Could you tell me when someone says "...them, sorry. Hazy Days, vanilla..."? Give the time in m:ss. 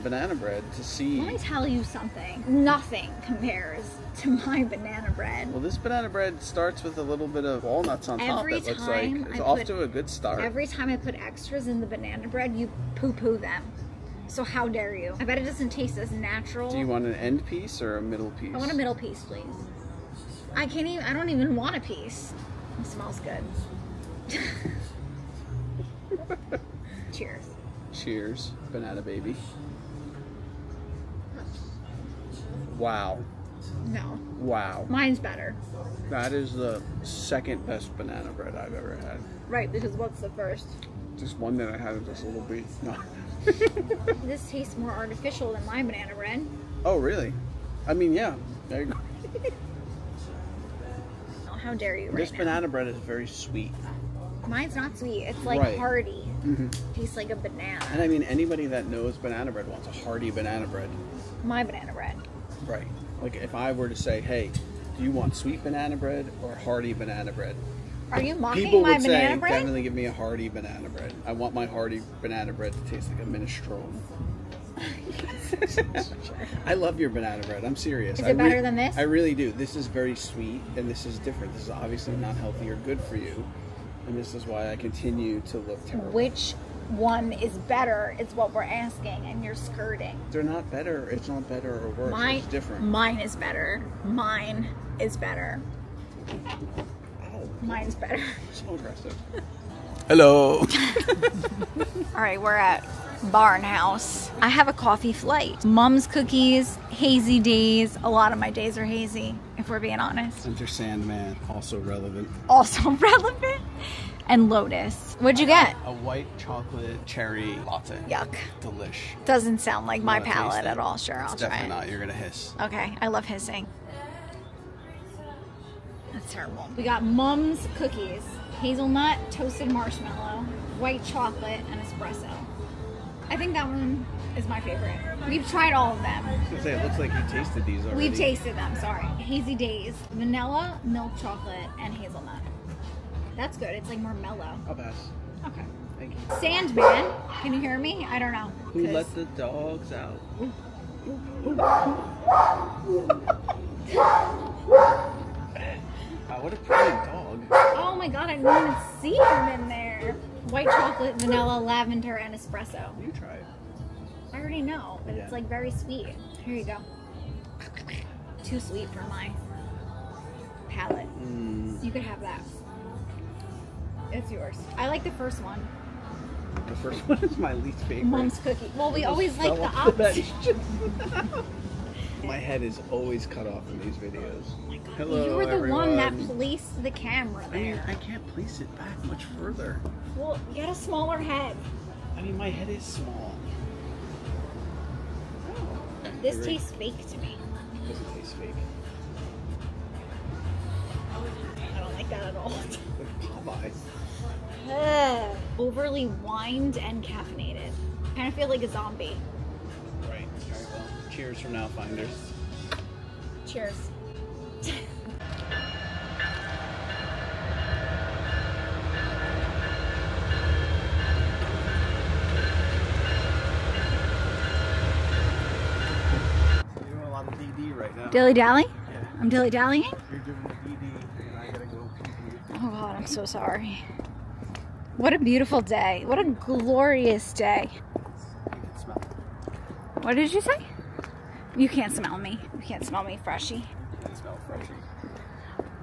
2:18.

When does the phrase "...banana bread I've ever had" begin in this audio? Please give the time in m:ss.
0:37.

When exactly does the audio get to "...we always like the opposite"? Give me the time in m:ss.
2:58.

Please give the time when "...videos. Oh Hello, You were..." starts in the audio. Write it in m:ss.
3:03.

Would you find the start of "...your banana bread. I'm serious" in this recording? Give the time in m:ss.
1:16.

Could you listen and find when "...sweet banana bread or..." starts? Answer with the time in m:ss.
1:05.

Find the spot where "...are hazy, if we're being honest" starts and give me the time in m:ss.
1:48.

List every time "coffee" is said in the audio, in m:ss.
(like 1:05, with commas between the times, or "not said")
1:44.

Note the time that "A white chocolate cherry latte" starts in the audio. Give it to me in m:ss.
1:55.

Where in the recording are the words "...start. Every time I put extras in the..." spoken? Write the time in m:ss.
0:10.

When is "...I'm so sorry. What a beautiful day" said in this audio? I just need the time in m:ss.
3:52.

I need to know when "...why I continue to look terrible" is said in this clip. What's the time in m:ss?
1:24.